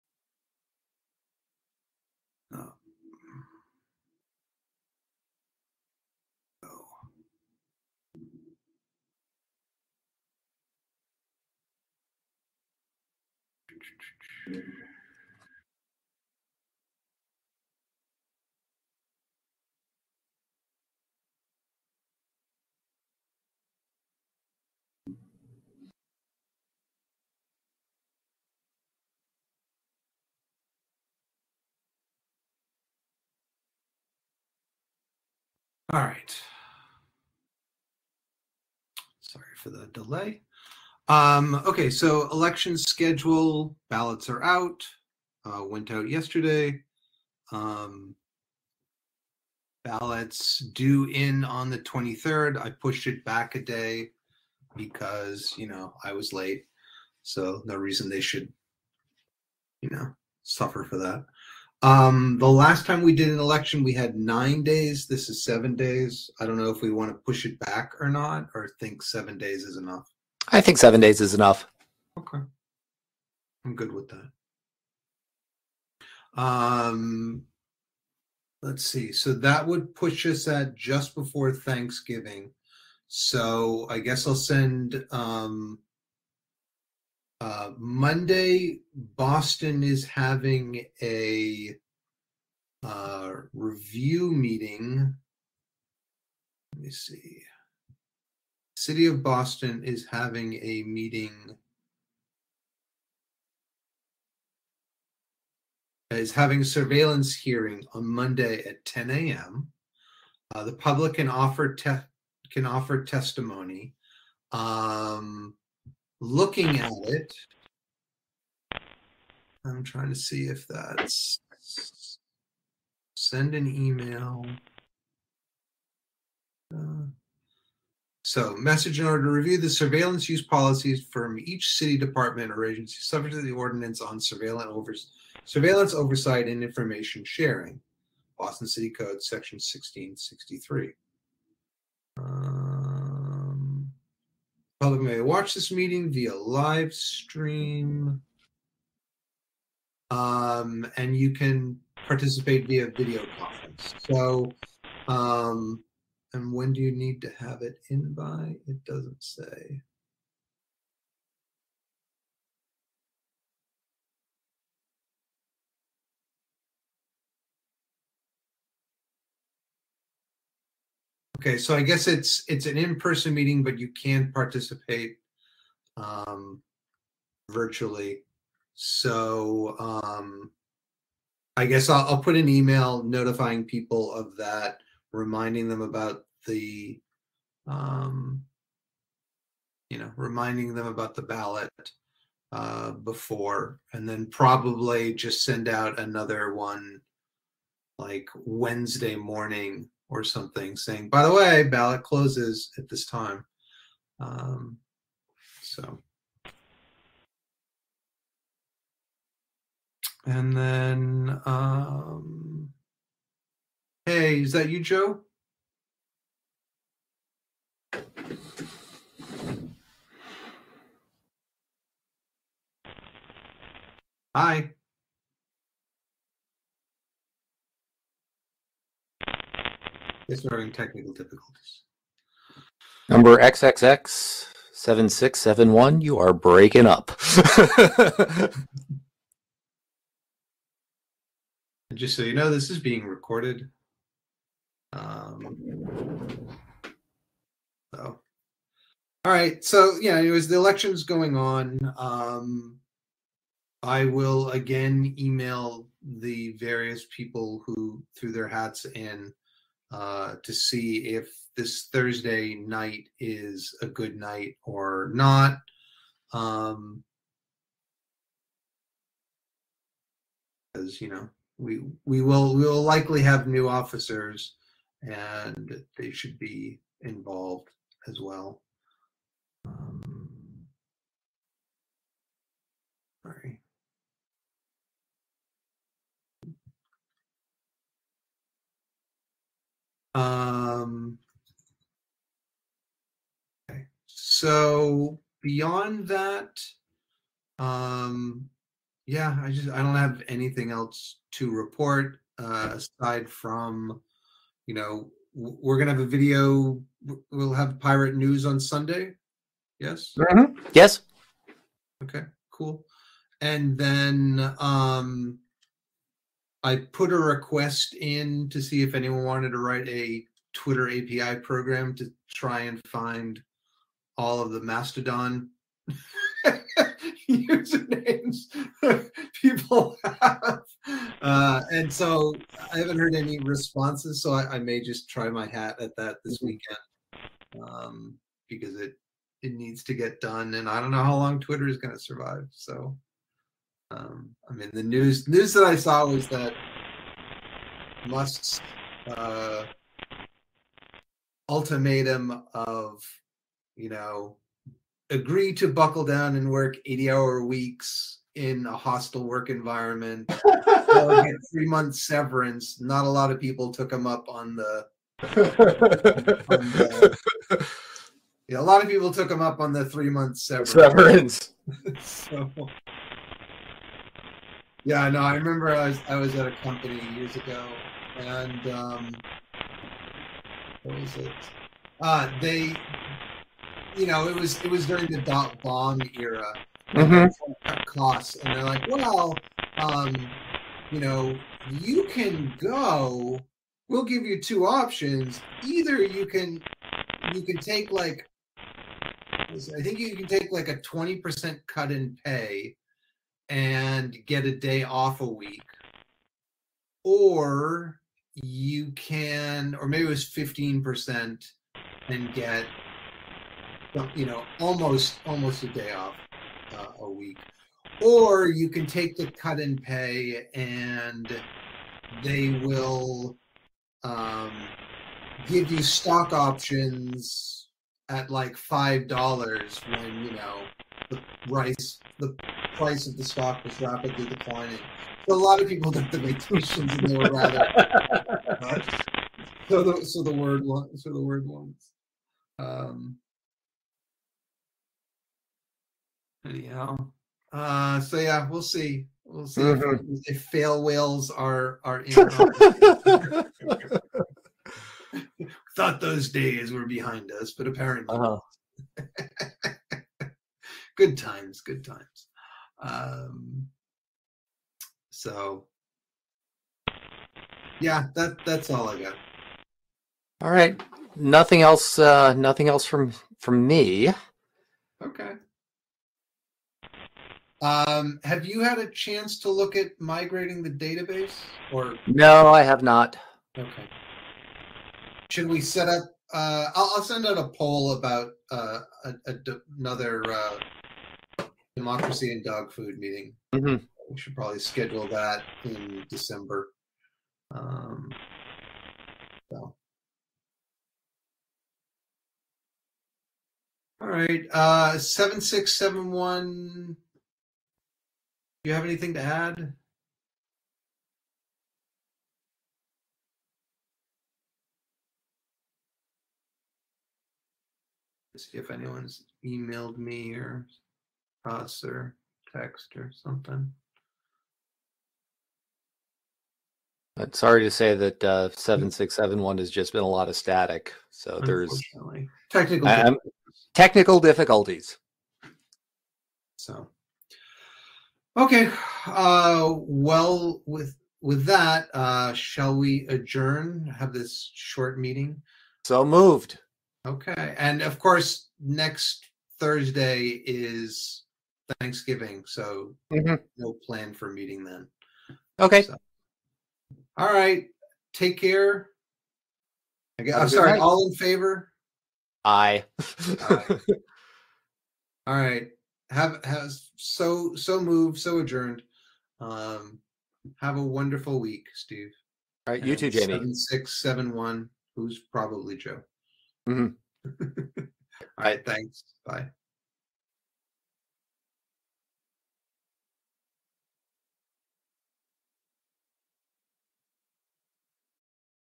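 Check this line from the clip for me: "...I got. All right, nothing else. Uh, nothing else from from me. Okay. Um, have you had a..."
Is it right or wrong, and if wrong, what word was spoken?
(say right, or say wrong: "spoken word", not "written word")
right.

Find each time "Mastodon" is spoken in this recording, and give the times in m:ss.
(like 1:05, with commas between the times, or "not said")
5:24.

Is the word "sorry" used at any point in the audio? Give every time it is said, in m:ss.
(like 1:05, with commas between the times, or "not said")
0:39, 4:43, 8:47, 9:20.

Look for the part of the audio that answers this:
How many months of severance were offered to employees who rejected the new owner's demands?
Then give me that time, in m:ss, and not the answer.
6:01.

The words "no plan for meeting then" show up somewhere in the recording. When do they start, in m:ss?
9:13.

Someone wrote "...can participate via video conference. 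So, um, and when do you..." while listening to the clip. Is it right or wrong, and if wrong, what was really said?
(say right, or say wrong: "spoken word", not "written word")
right.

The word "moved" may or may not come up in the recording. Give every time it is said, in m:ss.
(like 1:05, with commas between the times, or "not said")
9:06, 9:27.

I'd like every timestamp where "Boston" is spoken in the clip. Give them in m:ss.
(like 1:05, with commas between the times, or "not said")
1:28, 1:39, 2:18.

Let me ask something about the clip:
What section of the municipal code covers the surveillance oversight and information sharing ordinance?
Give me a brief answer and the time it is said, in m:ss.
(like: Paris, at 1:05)
Section 1663, at 2:19.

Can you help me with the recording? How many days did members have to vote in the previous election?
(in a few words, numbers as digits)
9.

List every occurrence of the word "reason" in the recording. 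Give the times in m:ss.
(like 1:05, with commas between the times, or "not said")
0:57.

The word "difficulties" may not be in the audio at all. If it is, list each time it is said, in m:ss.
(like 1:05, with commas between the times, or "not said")
3:51, 8:54.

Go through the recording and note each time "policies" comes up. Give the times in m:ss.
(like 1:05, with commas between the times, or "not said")
2:10.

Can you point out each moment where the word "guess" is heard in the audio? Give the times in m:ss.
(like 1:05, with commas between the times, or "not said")
1:23, 2:51, 3:01, 9:20.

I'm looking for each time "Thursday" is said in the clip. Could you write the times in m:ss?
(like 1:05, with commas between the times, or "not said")
4:21, 9:09.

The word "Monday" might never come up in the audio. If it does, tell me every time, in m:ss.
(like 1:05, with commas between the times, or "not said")
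1:27, 1:48.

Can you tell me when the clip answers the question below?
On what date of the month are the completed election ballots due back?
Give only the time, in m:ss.
0:51.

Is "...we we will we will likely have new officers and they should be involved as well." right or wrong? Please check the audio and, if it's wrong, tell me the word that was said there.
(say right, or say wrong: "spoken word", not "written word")
right.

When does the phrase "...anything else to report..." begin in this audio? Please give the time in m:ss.
5:00.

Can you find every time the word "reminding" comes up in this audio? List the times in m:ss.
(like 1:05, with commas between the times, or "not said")
3:05, 3:10.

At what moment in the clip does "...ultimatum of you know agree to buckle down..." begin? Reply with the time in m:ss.
5:51.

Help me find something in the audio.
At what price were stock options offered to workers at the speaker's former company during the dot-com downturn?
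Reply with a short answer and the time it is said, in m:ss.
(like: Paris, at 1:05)
$5, at 7:08.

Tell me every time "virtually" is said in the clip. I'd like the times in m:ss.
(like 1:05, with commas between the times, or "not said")
2:57.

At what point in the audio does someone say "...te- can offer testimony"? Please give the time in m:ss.
1:51.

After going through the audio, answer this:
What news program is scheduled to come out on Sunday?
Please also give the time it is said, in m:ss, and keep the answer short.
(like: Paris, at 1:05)
Pirate News, at 5:07.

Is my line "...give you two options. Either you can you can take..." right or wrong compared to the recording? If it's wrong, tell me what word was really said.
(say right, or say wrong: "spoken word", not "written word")
right.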